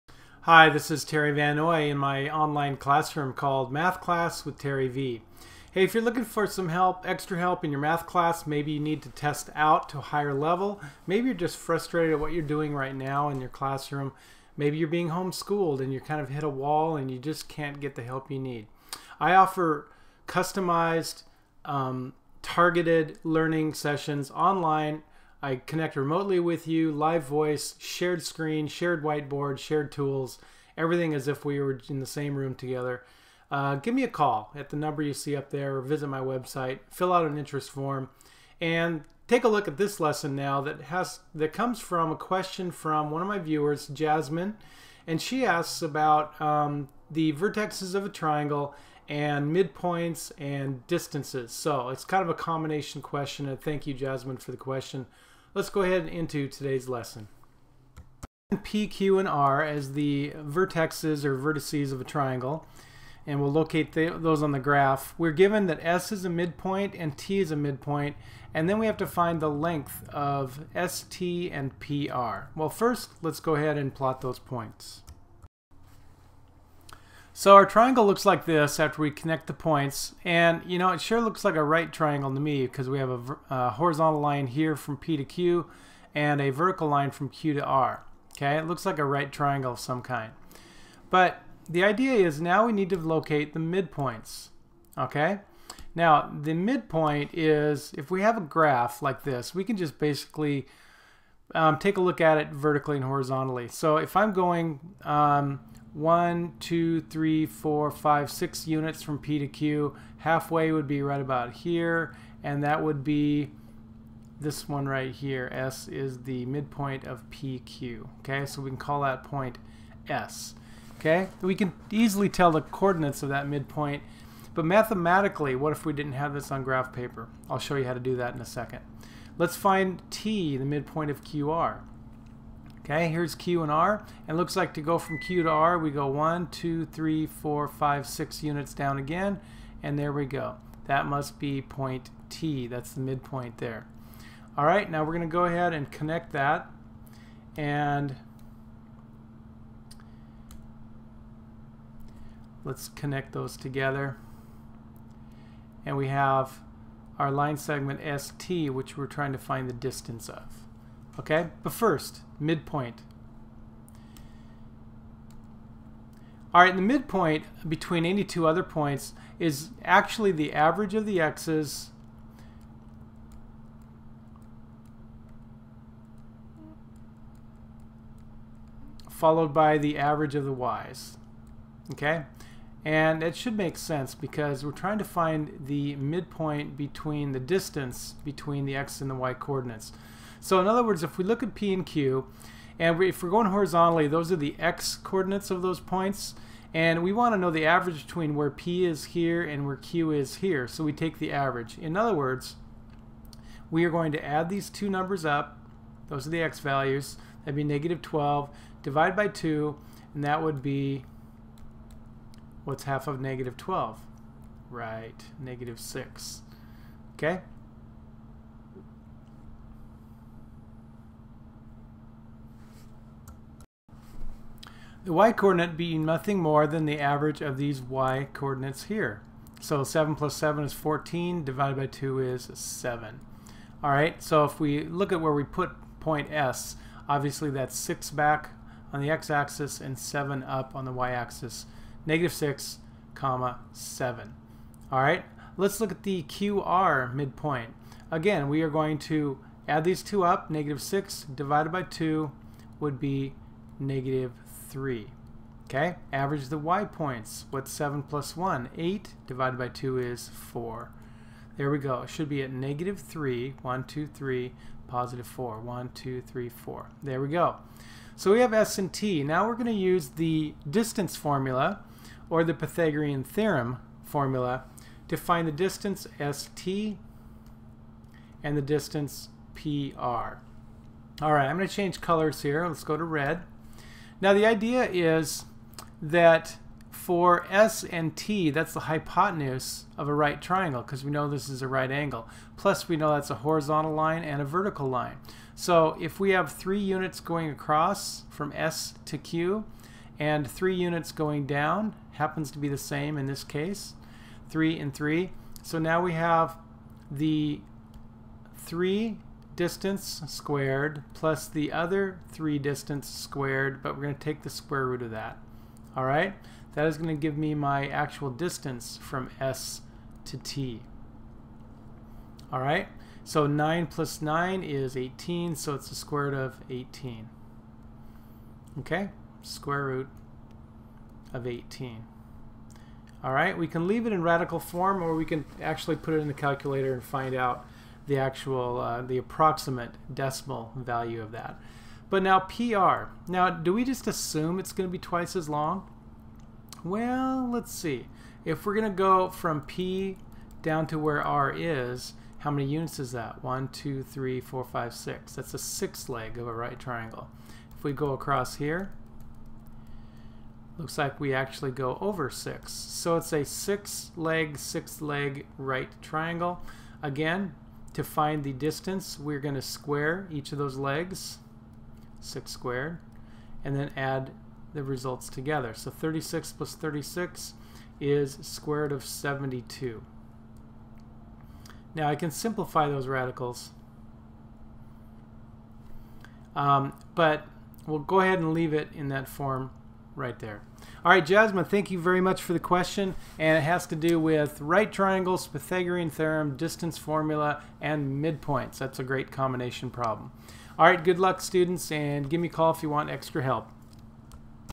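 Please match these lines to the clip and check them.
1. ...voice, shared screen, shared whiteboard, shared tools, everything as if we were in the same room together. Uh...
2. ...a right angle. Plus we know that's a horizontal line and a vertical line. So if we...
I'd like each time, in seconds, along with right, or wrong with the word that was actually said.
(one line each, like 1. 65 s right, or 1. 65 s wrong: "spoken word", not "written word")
1. 27 s right
2. 291 s right.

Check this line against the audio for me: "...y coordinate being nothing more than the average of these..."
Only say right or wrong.
right.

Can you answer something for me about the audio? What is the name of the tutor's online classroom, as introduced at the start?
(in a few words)
Math Class with Terry V.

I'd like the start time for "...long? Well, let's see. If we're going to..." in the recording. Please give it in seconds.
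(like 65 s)
345 s.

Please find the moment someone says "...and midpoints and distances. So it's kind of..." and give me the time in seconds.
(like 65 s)
49 s.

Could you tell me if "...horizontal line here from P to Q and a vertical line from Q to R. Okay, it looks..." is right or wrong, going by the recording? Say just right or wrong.
right.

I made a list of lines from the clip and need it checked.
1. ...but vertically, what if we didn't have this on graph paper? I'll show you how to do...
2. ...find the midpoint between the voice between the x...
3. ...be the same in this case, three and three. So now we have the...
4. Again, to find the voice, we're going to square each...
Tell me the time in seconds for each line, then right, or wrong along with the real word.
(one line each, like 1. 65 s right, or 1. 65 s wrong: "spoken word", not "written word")
1. 124 s wrong: "mathematically", not "vertically"
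2. 185 s wrong: "distance", not "voice"
3. 302 s right
4. 367 s wrong: "distance", not "voice".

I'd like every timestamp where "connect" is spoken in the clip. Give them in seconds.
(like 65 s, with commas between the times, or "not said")
25 s, 79 s, 145 s, 152 s.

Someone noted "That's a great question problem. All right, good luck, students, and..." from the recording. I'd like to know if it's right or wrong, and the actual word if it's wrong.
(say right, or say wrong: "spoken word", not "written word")
wrong: "combination", not "question".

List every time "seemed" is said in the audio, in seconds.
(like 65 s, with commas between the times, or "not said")
not said.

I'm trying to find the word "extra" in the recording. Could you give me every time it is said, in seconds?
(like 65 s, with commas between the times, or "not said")
7 s, 403 s.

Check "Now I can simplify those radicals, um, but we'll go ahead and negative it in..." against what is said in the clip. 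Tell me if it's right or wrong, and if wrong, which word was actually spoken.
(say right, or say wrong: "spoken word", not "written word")
wrong: "leave", not "negative".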